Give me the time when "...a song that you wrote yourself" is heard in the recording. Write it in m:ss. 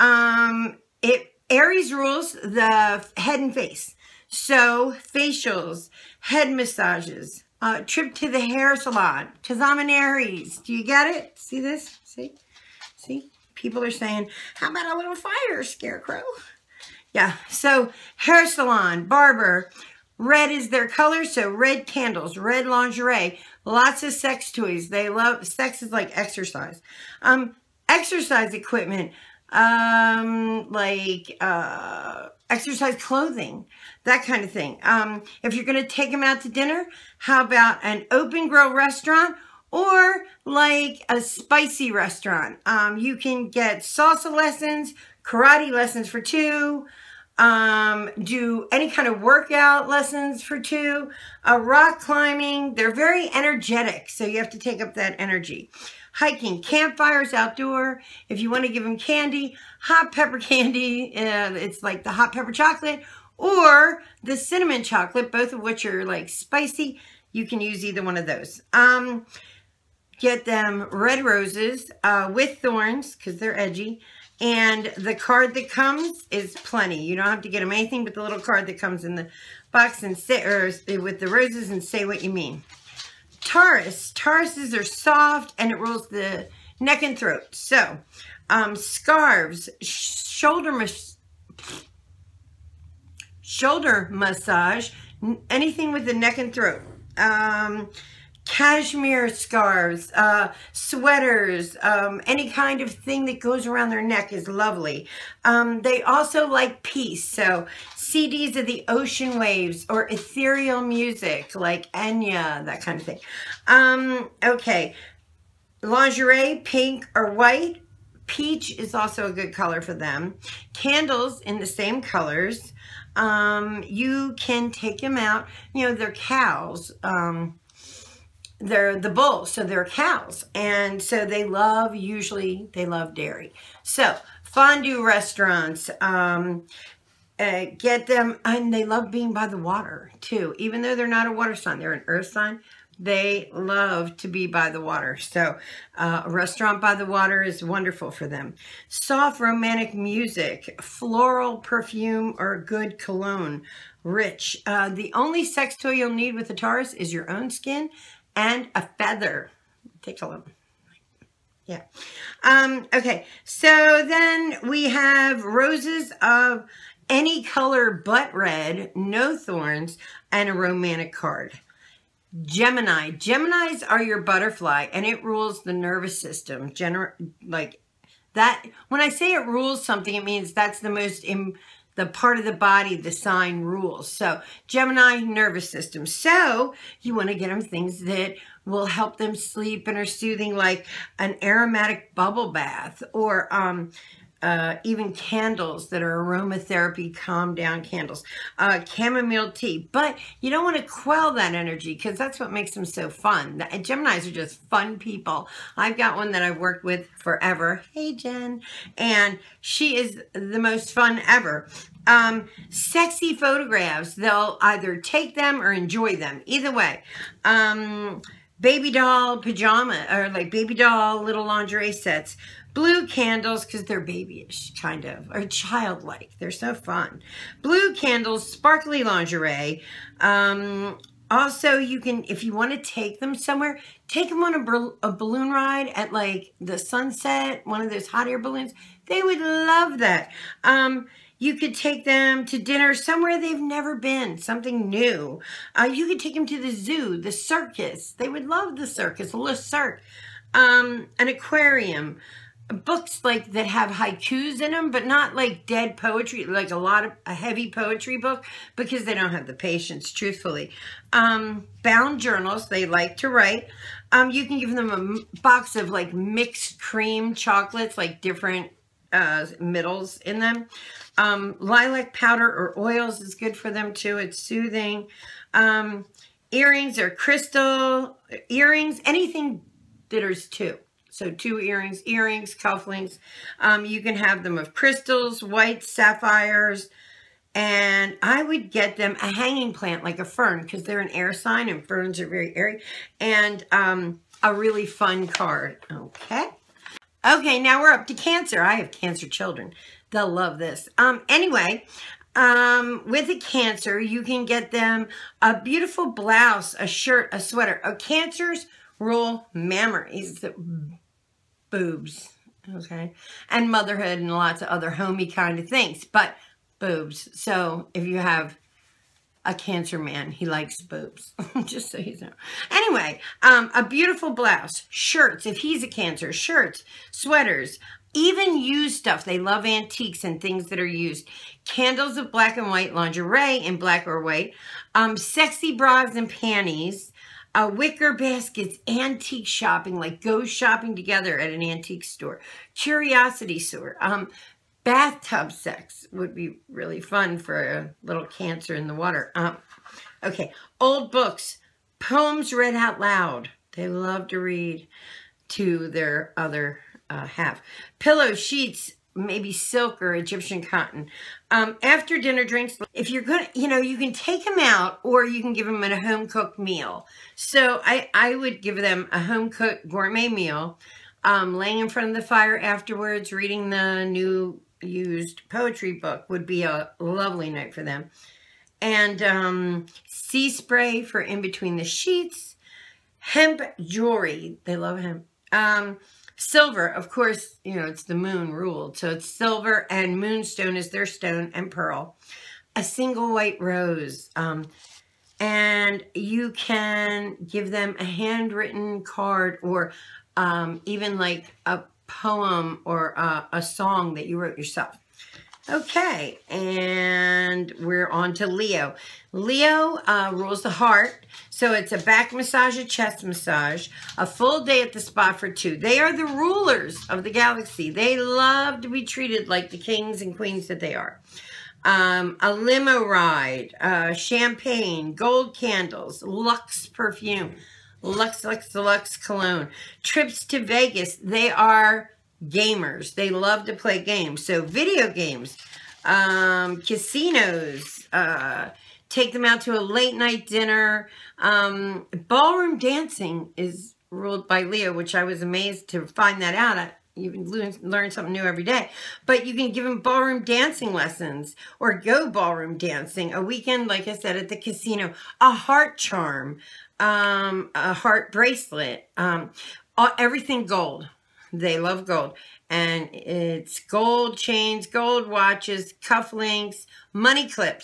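6:43.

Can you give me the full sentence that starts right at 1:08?
Um, get them red roses uh, with thorns because they're edgy.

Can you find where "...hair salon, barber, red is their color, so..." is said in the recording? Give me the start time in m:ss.
0:18.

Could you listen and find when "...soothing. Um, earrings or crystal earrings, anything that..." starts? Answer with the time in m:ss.
4:34.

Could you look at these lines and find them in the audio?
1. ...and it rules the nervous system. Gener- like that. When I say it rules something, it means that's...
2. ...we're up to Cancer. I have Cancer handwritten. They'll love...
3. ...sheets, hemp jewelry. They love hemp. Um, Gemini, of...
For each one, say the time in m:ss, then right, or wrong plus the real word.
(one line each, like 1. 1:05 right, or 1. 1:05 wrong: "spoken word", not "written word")
1. 2:54 right
2. 4:57 wrong: "children", not "handwritten"
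3. 6:21 wrong: "Silver", not "Gemini".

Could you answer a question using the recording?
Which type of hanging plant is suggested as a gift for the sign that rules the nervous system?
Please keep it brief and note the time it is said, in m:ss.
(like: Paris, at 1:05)
A fern, at 4:50.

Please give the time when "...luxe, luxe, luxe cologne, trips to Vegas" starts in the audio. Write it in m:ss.
7:08.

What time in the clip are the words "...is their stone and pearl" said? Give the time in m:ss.
6:30.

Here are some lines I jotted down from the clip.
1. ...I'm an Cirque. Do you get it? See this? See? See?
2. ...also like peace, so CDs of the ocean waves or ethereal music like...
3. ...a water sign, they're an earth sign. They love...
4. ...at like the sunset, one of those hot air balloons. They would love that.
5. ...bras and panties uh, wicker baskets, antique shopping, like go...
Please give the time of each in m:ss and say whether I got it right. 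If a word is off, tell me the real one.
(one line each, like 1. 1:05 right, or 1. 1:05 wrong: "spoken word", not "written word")
1. 0:09 wrong: "Aries", not "Cirque"
2. 1:46 right
3. 2:21 right
4. 3:55 right
5. 5:35 right.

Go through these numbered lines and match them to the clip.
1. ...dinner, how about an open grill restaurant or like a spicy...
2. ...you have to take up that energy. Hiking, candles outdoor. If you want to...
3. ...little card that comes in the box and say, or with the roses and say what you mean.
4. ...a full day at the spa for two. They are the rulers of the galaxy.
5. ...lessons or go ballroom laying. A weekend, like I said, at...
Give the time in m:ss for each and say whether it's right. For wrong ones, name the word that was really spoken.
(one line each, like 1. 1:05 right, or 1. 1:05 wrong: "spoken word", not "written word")
1. 0:36 right
2. 0:54 wrong: "campfires", not "candles"
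3. 1:18 right
4. 6:54 right
5. 7:30 wrong: "dancing", not "laying".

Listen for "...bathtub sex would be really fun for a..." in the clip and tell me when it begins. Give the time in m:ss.
5:44.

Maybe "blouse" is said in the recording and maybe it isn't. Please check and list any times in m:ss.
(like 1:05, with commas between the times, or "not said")
5:06, 5:24.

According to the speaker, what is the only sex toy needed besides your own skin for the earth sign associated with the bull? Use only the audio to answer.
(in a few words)
A feather.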